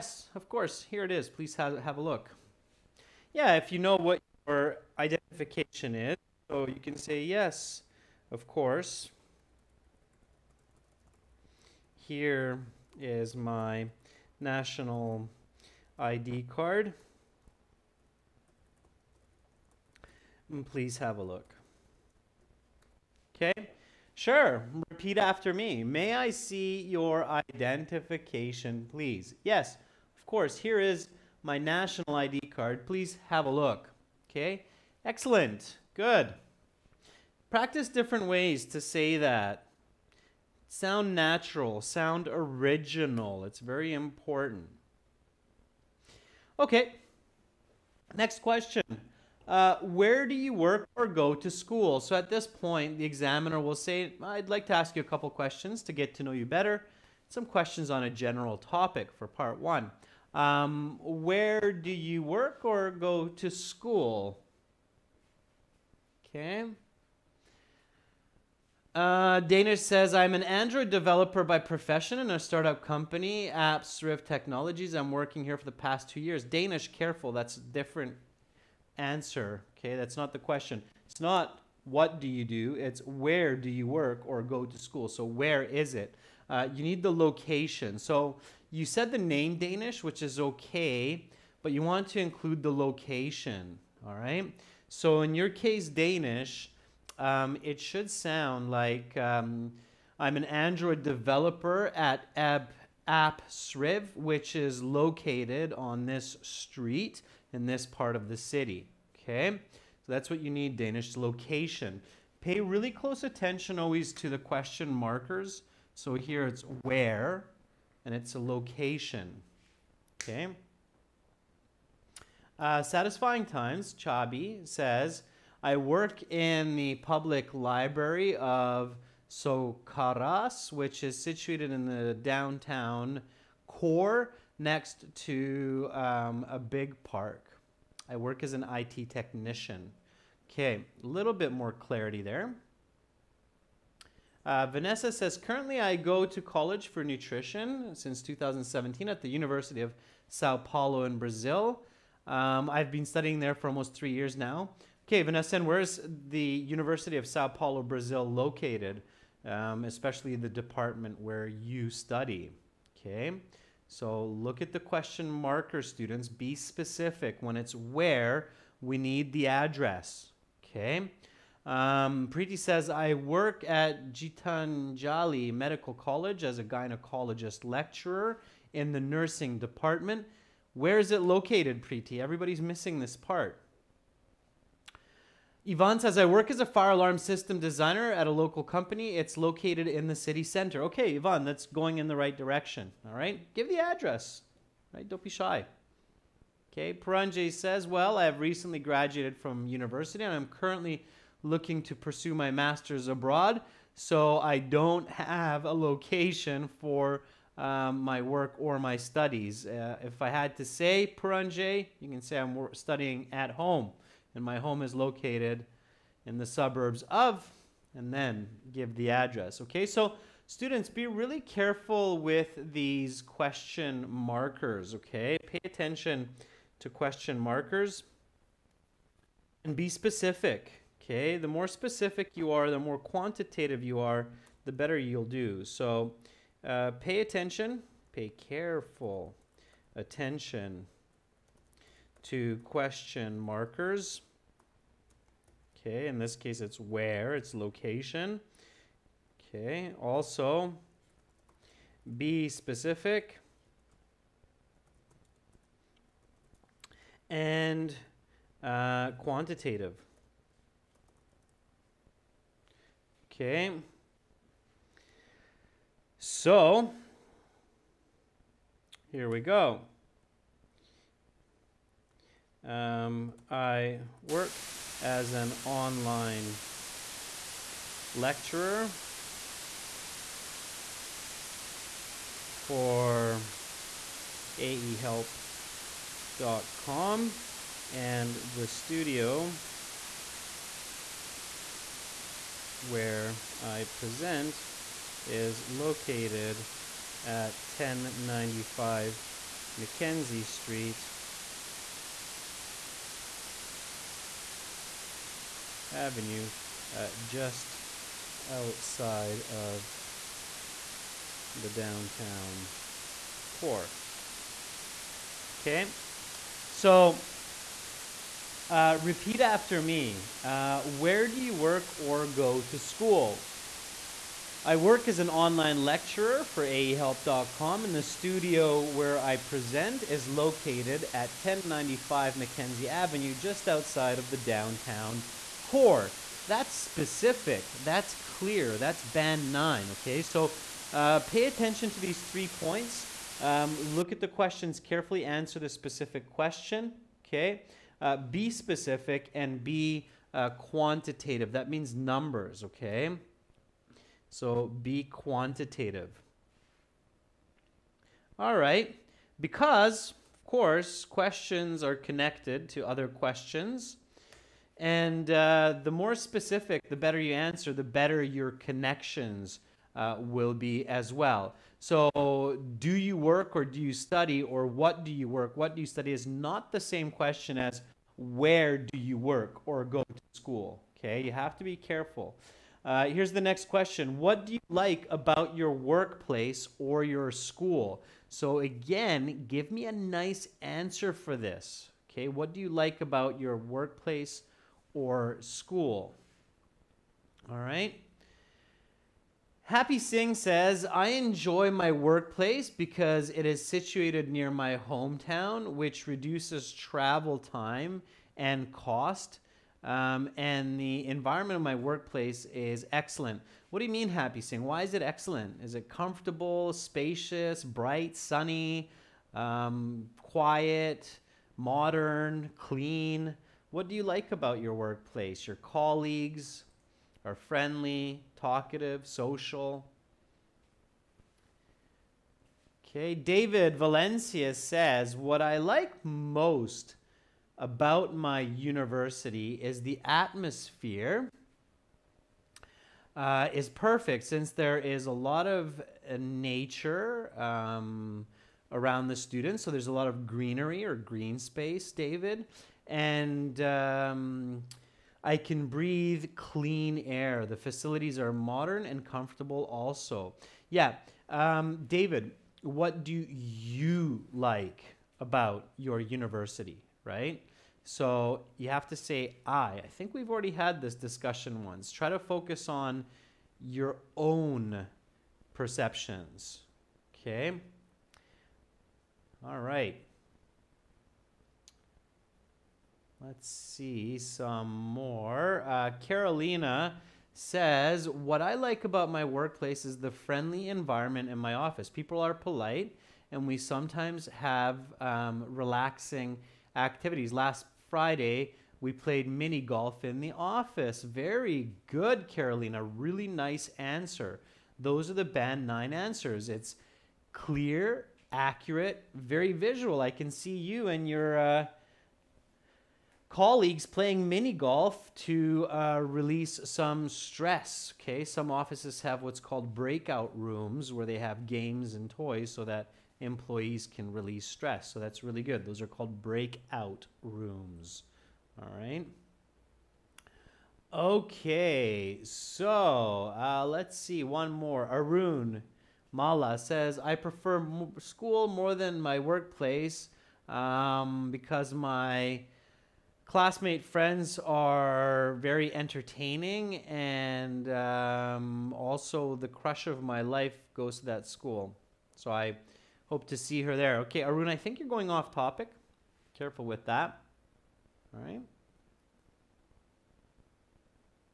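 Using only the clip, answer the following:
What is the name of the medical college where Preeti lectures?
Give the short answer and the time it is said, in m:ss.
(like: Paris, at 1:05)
Gitanjali Medical College, at 2:54.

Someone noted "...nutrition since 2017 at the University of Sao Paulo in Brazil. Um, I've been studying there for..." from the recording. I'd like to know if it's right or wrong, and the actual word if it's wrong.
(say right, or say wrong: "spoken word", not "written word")
right.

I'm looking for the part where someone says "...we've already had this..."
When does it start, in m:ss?
7:50.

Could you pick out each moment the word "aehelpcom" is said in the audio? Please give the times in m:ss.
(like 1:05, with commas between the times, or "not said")
4:44, 5:26.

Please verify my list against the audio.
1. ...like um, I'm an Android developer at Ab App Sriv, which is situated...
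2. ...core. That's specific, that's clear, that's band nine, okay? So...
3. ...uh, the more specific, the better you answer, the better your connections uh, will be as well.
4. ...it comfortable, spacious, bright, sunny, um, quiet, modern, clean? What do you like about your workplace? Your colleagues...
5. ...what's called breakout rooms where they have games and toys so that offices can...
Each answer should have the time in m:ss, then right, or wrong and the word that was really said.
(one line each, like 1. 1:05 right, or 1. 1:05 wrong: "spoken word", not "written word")
1. 1:38 wrong: "located", not "situated"
2. 5:35 right
3. 6:05 right
4. 6:55 right
5. 8:39 wrong: "employees", not "offices".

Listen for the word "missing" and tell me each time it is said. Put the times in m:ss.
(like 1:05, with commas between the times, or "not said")
3:02.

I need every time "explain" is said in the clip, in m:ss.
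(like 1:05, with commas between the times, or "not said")
not said.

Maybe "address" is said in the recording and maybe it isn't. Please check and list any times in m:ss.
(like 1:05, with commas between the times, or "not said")
2:49, 3:13, 3:39.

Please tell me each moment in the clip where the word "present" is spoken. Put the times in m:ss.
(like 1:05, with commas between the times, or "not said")
4:53, 5:29.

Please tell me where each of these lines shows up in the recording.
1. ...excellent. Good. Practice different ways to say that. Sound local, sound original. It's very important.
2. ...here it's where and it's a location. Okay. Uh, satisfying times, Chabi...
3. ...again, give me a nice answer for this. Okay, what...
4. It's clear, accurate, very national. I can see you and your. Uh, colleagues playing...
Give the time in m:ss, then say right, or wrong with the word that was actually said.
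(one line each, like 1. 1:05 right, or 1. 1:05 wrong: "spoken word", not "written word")
1. 0:35 wrong: "natural", not "local"
2. 1:56 right
3. 6:28 right
4. 8:26 wrong: "visual", not "national".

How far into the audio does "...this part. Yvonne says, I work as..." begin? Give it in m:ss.
3:02.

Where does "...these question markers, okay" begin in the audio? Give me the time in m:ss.
3:42.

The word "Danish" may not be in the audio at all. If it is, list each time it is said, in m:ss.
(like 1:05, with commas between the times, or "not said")
1:09, 1:16, 1:29, 1:35, 1:50.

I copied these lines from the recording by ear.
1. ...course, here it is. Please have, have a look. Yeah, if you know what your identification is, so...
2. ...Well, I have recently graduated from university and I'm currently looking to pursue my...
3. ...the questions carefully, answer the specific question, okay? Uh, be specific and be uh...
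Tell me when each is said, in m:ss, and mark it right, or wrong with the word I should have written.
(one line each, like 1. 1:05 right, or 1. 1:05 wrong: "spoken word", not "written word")
1. 0:00 right
2. 3:17 right
3. 5:44 right.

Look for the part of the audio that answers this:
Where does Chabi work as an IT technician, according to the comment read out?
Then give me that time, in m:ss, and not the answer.
2:06.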